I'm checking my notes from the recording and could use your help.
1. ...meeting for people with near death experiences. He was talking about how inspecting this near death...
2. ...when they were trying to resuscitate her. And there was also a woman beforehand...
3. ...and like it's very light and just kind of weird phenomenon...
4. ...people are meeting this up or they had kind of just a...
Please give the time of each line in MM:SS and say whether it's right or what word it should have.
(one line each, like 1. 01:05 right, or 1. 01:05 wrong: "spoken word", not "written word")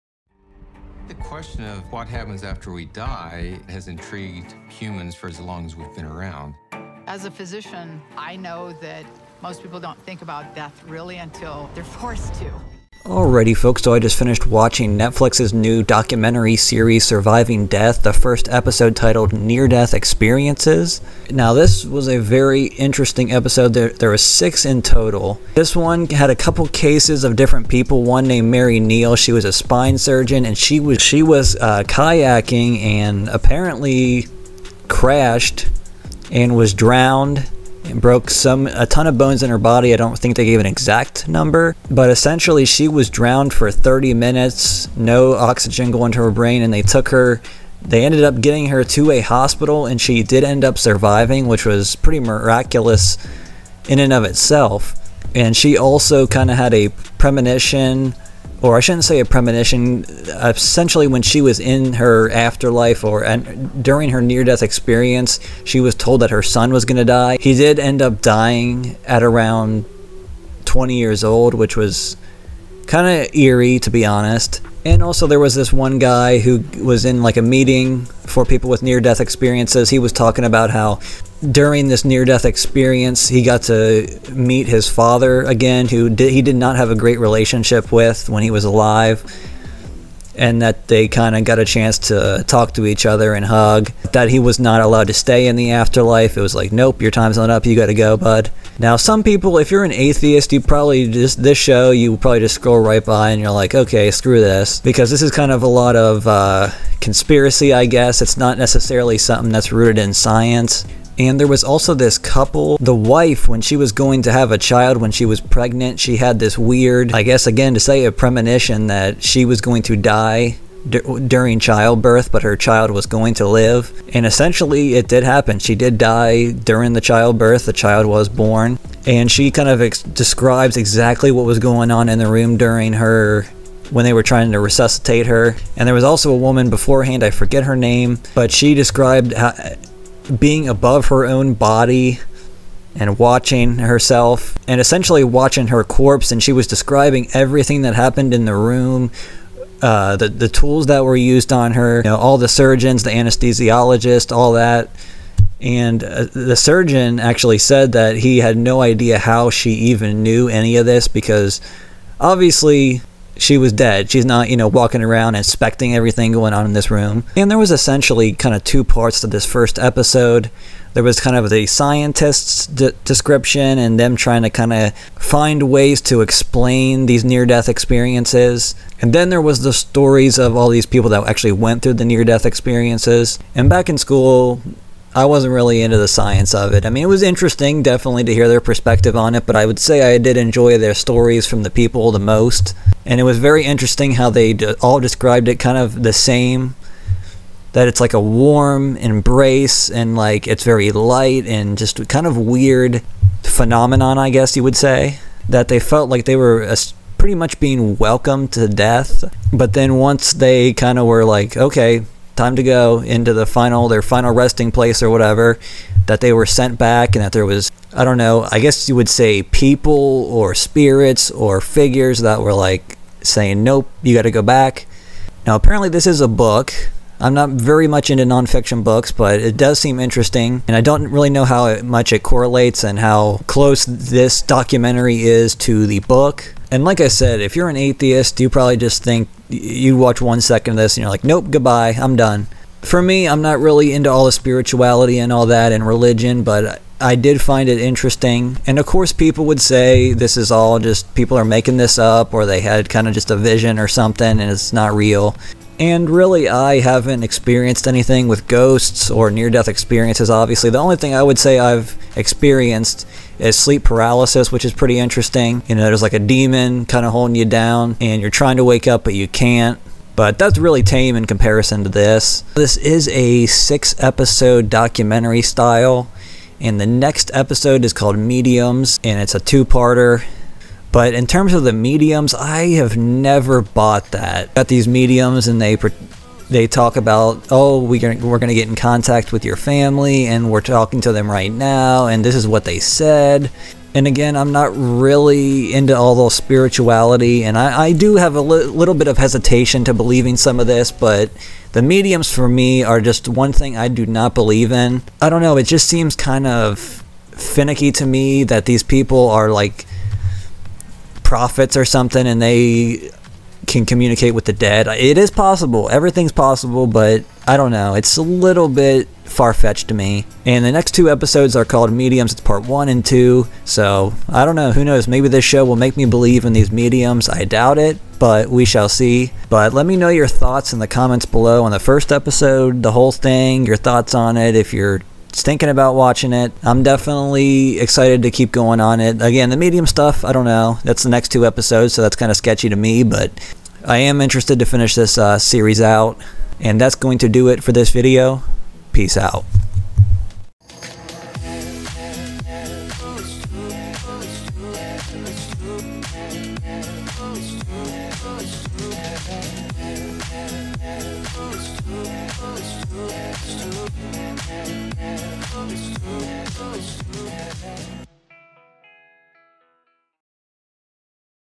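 1. 01:17 wrong: "during", not "inspecting"
2. 02:13 right
3. 03:19 right
4. 04:11 wrong: "making", not "meeting".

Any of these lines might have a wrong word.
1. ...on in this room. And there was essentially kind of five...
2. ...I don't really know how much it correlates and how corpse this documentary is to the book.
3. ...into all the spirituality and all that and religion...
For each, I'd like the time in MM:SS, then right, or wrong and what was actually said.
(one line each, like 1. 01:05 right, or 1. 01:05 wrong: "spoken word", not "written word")
1. 02:46 wrong: "two", not "five"
2. 03:50 wrong: "close", not "corpse"
3. 04:03 right.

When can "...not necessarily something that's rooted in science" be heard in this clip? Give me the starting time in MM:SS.
01:48.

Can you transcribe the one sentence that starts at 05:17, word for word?
It's a little bit far fetched to me.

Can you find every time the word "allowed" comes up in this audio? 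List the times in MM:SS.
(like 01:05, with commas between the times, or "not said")
01:34.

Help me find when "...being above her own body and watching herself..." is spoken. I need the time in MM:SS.
02:20.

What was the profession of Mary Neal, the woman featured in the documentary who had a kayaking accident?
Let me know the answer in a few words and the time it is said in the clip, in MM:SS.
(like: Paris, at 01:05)
spine surgeon, at 00:29.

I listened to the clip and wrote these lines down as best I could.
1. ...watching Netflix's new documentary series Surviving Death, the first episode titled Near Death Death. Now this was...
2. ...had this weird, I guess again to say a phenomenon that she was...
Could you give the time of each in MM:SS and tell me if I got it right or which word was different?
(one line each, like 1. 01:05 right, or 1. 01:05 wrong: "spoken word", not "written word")
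1. 00:14 wrong: "Experiences", not "Death"
2. 01:56 wrong: "premonition", not "phenomenon".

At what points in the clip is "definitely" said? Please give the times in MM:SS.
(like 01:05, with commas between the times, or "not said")
03:07, 05:36.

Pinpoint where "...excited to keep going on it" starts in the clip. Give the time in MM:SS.
05:37.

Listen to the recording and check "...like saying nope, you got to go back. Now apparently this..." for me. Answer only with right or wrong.
right.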